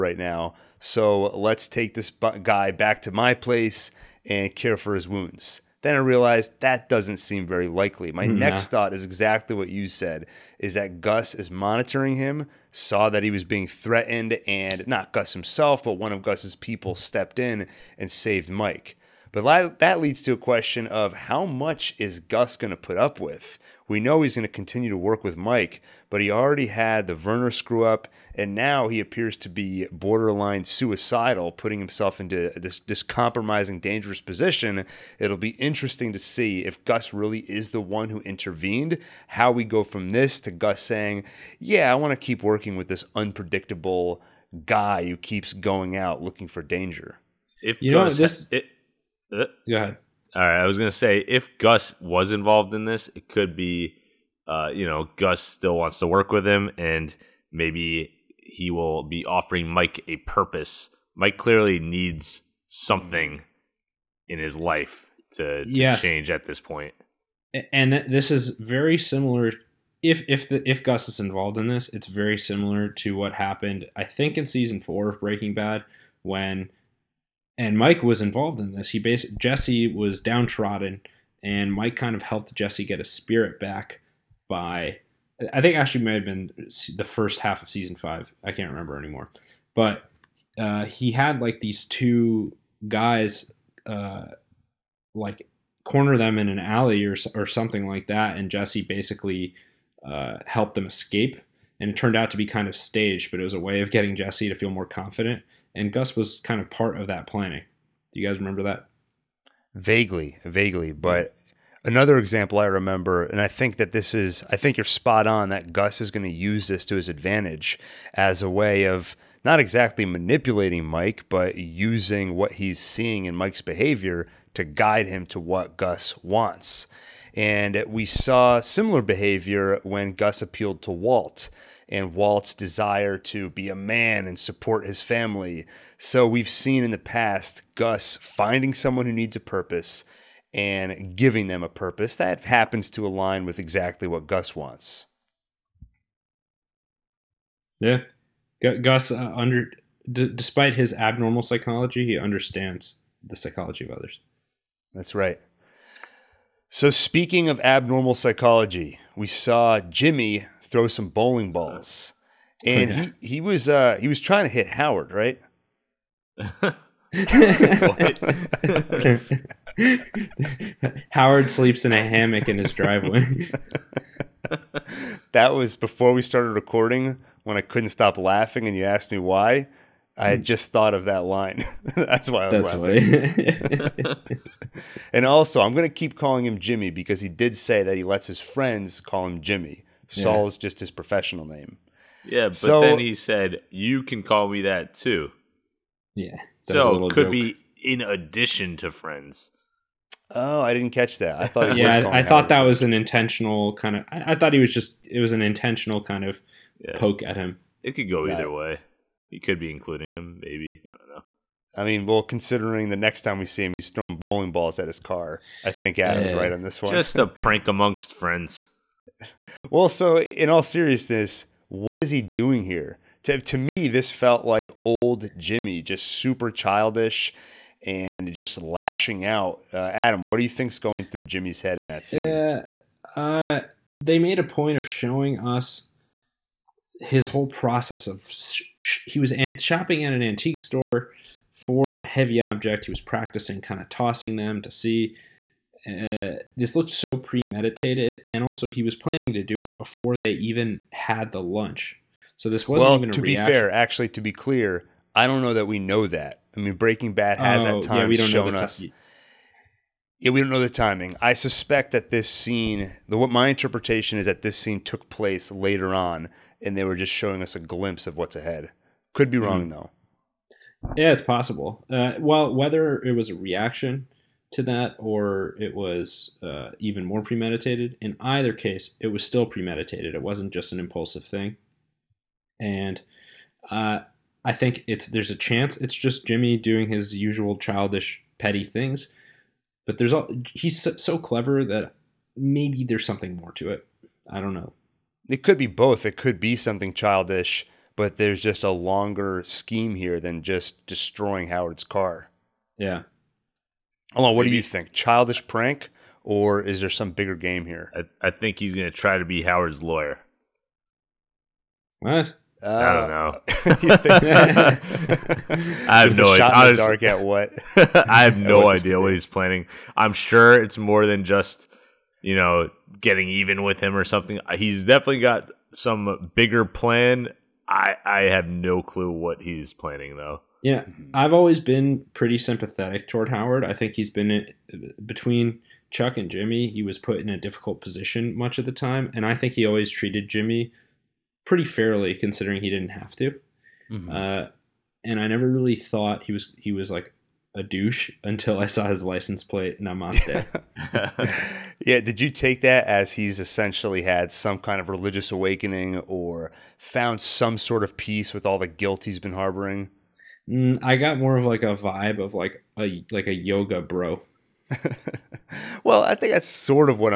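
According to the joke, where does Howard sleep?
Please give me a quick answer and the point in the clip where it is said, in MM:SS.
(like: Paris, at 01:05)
a hammock in his driveway, at 02:52.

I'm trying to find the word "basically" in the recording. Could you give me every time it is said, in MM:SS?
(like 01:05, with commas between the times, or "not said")
01:18, 01:38.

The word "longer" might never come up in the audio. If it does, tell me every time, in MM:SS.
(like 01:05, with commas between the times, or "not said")
04:58.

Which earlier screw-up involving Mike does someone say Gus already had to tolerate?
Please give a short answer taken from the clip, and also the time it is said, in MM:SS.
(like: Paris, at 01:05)
Werner, at 00:27.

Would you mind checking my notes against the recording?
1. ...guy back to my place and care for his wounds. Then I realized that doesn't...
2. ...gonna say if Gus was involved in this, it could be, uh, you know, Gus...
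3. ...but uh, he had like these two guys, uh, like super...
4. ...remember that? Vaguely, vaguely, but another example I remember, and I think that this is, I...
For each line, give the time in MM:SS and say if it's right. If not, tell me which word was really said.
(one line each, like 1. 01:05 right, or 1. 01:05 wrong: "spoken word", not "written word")
1. 00:02 right
2. 00:50 right
3. 01:29 wrong: "corner", not "super"
4. 01:48 right.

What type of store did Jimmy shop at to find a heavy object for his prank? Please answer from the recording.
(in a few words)
antique store.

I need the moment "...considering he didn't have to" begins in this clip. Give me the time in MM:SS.
05:42.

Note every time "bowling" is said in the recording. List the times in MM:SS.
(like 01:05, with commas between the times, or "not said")
02:41, 03:34.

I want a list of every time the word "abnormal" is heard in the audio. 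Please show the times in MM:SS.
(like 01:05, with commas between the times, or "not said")
02:30, 02:37.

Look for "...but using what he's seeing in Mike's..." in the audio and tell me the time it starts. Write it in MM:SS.
02:01.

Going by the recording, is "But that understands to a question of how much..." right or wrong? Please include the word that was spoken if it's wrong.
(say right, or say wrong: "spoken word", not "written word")
wrong: "leads", not "understands".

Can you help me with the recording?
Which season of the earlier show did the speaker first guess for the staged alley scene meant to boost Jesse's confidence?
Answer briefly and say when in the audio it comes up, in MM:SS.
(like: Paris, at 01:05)
season four, at 01:14.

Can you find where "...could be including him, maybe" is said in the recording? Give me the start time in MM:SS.
03:29.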